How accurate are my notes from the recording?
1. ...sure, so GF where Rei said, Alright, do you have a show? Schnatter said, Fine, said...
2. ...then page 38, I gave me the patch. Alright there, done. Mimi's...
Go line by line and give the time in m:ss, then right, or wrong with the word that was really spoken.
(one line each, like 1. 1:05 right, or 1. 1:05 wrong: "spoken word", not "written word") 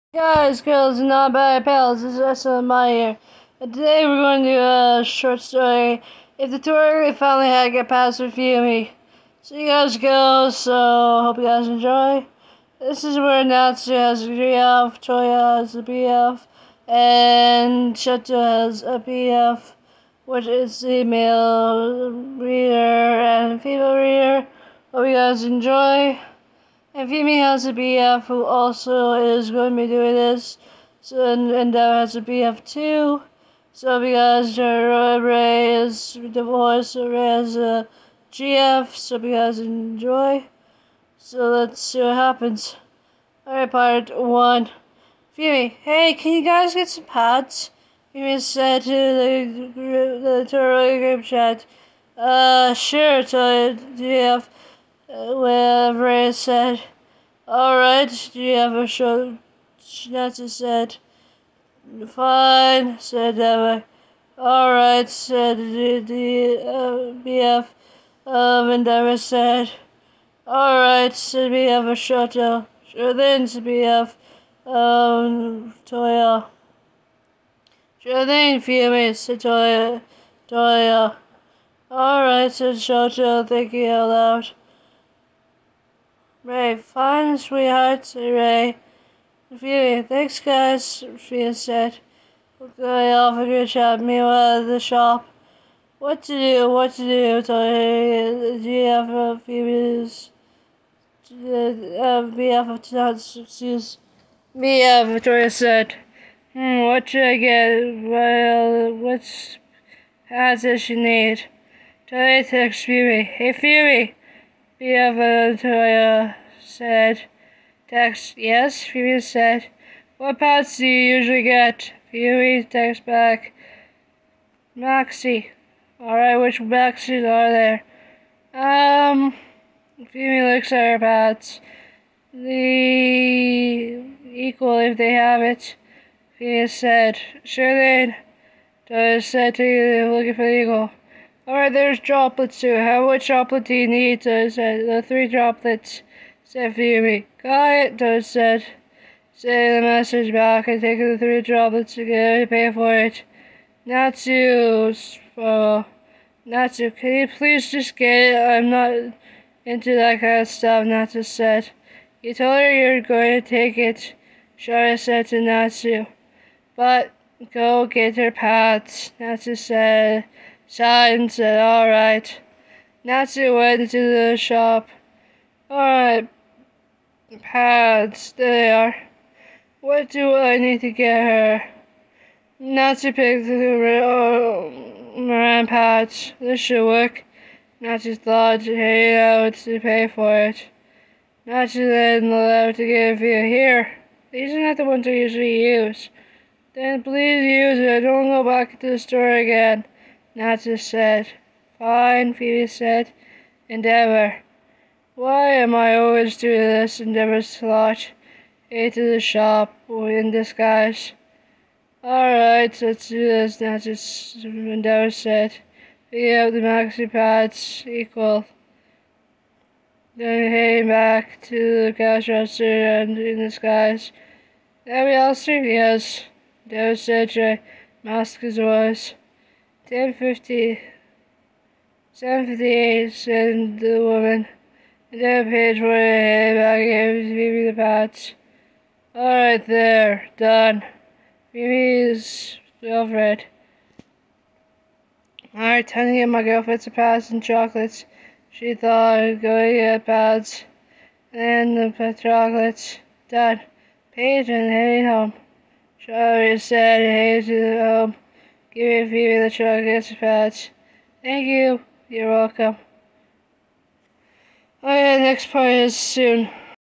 1. 0:52 right
2. 3:55 wrong: "28", not "38".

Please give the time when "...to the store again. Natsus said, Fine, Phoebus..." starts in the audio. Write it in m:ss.
3:18.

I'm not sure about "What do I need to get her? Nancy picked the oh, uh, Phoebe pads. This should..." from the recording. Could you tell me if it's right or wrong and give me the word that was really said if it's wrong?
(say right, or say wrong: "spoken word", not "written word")
wrong: "Moran", not "Phoebe".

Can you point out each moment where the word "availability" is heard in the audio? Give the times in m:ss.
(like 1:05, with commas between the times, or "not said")
not said.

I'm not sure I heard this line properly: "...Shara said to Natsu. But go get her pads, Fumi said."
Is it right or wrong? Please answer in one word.
wrong.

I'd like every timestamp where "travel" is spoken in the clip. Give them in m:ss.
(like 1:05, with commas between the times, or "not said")
not said.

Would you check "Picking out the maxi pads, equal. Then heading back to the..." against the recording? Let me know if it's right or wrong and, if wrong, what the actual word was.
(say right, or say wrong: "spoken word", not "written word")
right.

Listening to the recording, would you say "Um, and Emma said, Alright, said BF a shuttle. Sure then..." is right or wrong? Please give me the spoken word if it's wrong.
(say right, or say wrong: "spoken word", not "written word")
right.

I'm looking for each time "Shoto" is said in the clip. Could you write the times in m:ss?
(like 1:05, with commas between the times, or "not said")
0:17, 1:22.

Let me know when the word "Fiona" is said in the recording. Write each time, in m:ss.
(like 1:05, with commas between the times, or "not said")
1:54, 1:58, 2:10, 2:16.